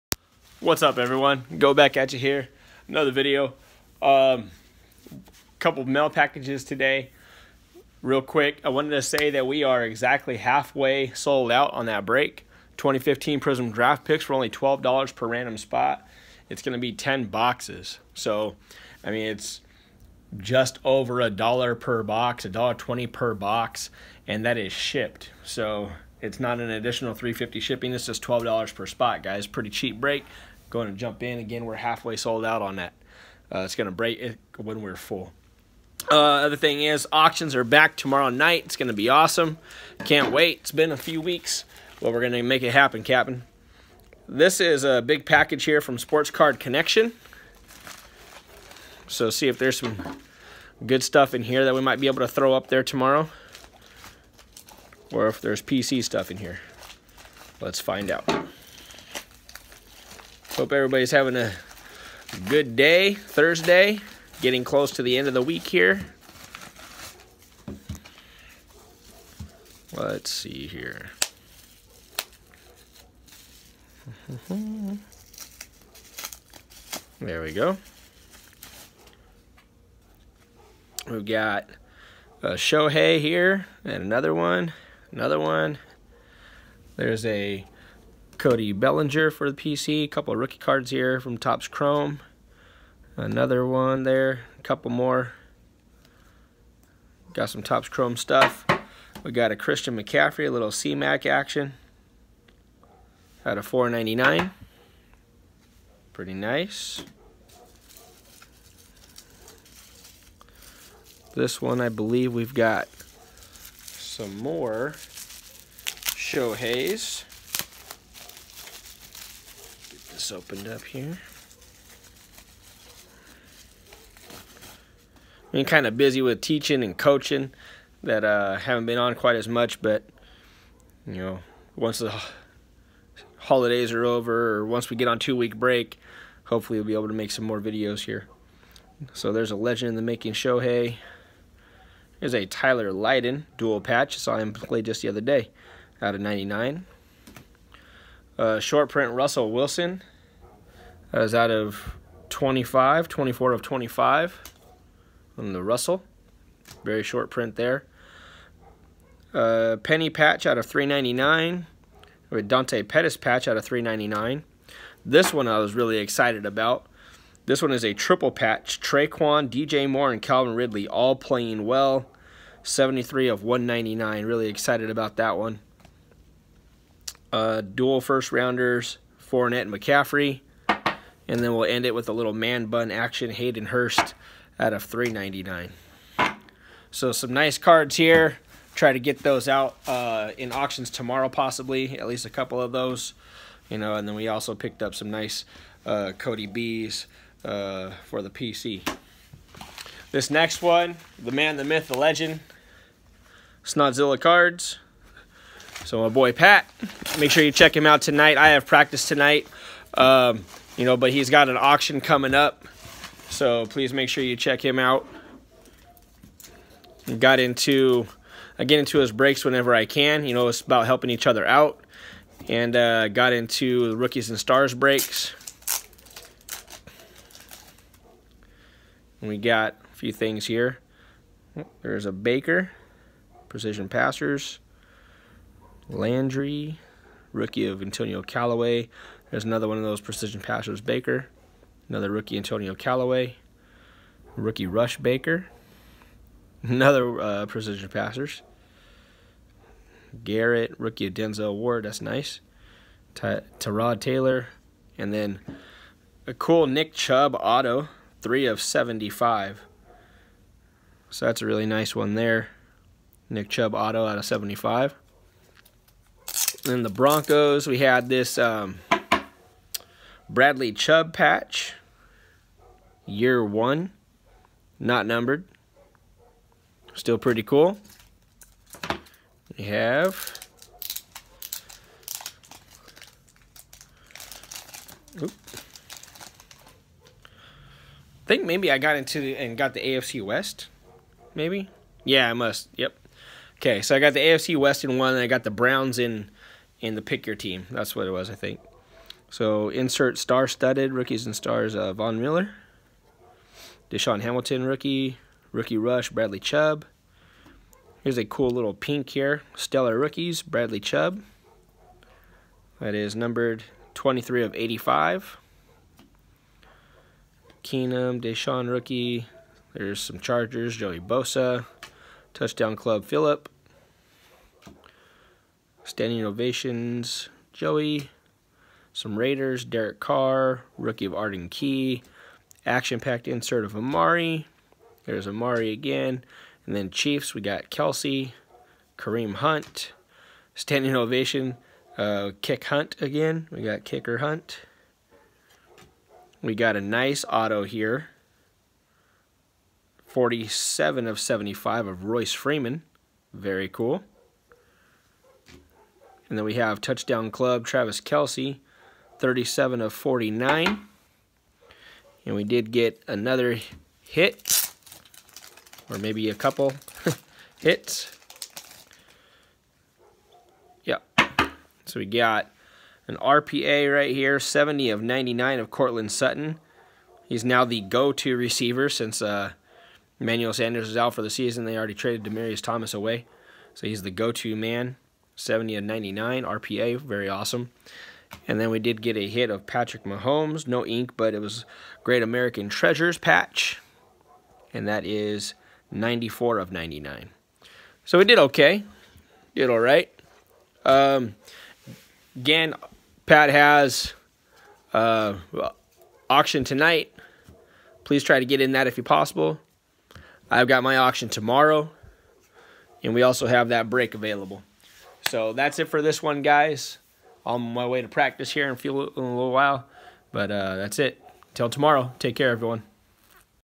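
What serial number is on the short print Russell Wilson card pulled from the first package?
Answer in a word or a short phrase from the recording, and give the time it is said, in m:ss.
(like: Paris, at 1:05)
24 of 25, at 2:33.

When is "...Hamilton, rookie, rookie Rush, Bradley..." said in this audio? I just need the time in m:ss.
5:04.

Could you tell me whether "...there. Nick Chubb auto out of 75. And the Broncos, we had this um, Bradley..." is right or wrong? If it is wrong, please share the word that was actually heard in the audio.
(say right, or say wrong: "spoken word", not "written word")
right.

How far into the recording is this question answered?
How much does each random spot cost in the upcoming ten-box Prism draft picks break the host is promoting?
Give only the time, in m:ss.
0:14.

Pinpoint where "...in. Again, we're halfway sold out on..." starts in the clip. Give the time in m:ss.
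0:31.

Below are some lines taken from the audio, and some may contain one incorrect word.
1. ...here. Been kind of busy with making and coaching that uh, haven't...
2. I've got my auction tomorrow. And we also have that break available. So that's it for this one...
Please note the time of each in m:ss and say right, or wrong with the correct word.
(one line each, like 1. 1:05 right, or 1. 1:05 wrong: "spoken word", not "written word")
1. 2:00 wrong: "teaching", not "making"
2. 6:50 right.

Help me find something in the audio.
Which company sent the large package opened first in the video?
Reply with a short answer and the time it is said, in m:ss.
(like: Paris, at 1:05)
Sports Card Connection, at 0:45.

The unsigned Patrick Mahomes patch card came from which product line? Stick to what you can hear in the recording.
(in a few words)
Great American Treasures.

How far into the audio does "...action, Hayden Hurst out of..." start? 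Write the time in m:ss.
3:02.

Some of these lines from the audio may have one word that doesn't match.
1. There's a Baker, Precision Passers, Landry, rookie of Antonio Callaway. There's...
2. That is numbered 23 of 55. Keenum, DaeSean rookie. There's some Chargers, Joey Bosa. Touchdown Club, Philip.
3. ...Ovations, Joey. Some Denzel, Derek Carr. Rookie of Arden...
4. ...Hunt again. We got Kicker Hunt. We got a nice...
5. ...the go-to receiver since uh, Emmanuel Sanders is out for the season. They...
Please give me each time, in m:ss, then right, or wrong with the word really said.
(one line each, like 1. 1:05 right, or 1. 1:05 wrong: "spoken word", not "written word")
1. 3:51 right
2. 5:12 wrong: "85", not "55"
3. 5:26 wrong: "Raiders", not "Denzel"
4. 5:42 right
5. 6:17 right.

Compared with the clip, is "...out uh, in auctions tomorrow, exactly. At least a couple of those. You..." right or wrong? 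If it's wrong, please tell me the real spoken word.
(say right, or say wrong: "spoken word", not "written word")
wrong: "possibly", not "exactly".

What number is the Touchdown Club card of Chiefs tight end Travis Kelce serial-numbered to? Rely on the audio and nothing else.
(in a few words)
37 of 49.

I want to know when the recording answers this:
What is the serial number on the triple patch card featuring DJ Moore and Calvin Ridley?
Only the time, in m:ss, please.
2:52.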